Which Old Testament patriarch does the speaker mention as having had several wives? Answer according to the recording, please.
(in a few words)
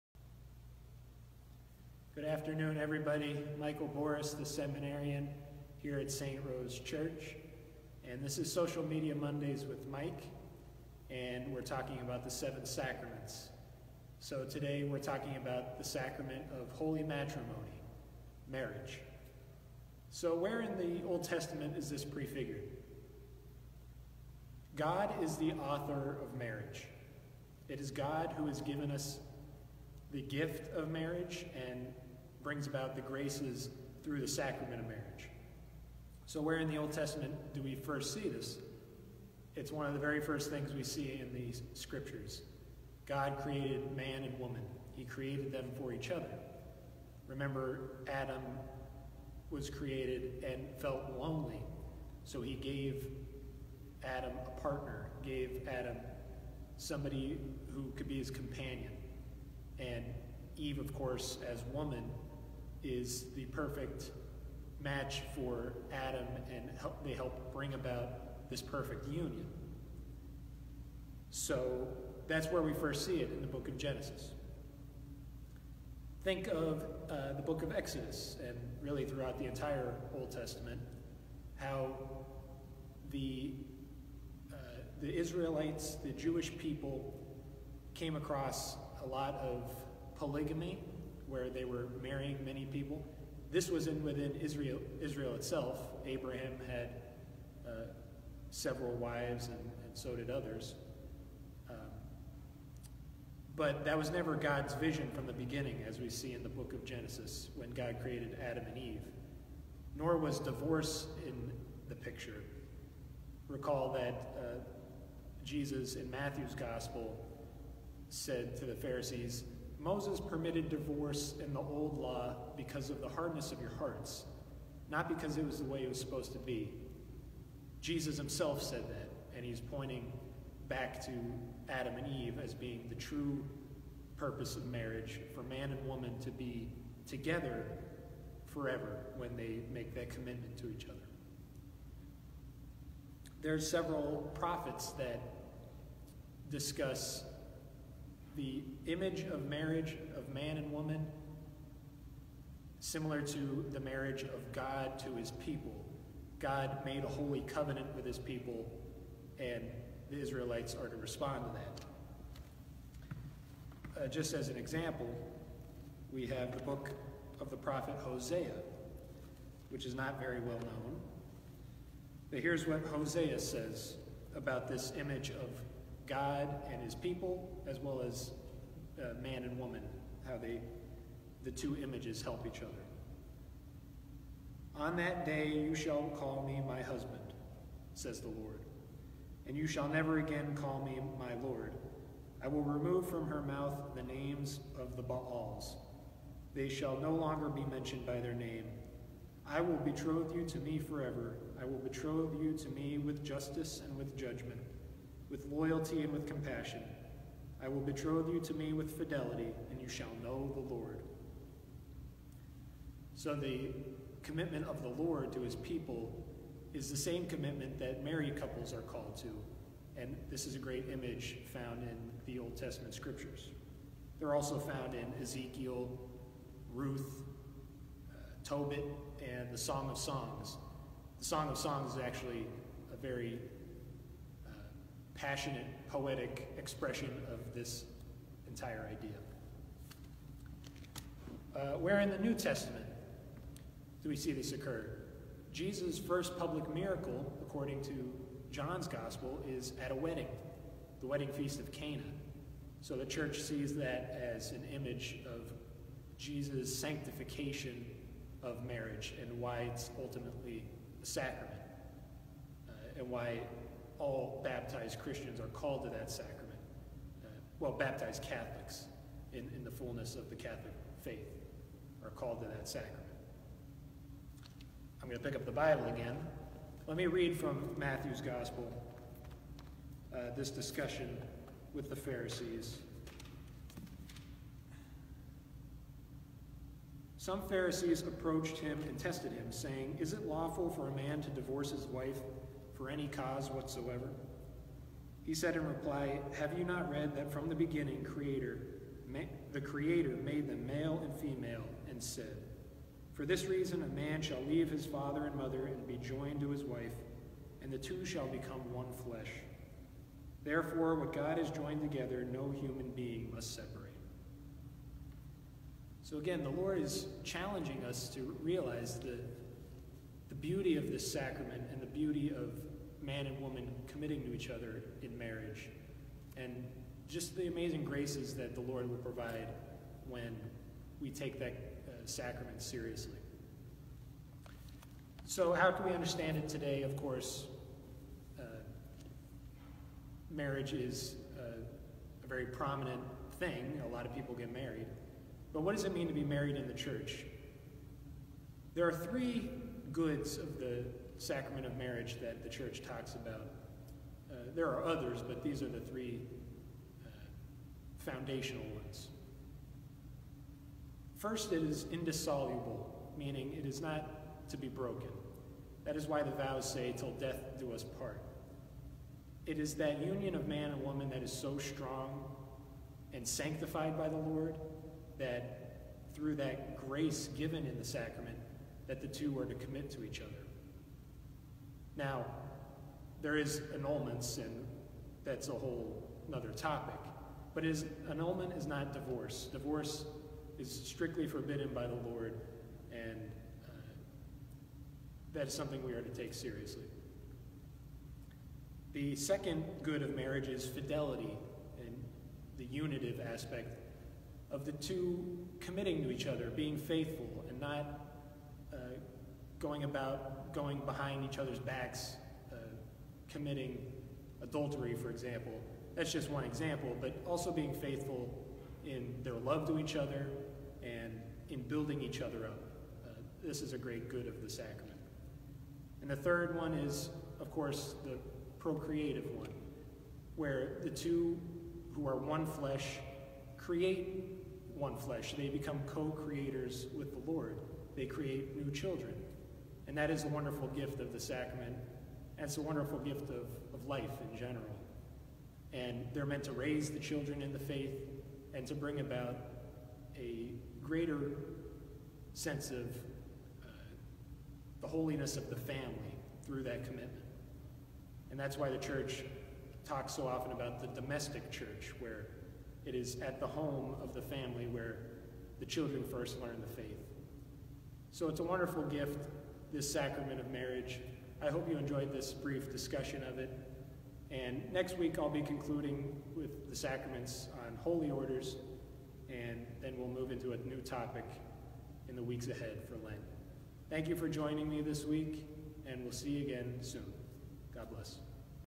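Abraham.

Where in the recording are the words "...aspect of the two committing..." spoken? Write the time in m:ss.
6:43.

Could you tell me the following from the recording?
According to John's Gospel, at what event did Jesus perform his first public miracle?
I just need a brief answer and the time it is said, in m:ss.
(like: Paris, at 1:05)
wedding feast of Cana, at 4:11.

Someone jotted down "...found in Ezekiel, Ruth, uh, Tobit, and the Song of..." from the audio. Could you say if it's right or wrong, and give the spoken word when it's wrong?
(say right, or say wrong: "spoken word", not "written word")
right.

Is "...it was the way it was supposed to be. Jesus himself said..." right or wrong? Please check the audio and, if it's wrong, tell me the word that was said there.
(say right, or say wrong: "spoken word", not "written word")
right.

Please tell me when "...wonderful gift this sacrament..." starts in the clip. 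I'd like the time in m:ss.
7:48.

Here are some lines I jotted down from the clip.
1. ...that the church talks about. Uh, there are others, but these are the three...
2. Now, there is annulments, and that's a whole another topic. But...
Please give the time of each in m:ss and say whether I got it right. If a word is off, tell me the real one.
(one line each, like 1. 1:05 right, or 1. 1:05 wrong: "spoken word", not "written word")
1. 5:52 right
2. 6:22 right.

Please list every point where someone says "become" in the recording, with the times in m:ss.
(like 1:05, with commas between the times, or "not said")
5:08, 7:15.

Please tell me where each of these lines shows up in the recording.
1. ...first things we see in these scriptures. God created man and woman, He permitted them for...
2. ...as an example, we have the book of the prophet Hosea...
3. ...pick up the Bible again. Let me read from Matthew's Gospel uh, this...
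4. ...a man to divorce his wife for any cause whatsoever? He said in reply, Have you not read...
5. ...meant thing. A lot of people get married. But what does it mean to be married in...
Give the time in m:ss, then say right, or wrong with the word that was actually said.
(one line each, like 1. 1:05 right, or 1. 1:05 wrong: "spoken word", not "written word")
1. 0:40 wrong: "created", not "permitted"
2. 2:44 right
3. 4:35 right
4. 4:50 right
5. 5:42 wrong: "prominent", not "meant".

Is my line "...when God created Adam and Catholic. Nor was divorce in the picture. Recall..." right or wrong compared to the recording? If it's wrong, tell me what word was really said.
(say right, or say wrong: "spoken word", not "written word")
wrong: "Eve", not "Catholic".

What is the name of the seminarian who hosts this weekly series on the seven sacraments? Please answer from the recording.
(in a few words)
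Michael Boris.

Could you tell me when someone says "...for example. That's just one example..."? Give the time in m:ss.
6:54.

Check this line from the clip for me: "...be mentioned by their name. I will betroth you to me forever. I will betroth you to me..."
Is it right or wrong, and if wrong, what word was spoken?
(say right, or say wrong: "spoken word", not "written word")
right.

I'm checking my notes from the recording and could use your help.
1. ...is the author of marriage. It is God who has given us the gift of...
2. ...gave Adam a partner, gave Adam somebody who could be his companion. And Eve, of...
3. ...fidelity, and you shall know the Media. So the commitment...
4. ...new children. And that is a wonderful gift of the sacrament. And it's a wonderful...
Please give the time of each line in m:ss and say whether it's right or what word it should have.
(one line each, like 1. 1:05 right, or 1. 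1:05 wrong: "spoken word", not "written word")
1. 0:25 right
2. 0:52 right
3. 3:28 wrong: "Lord", not "Media"
4. 7:18 right.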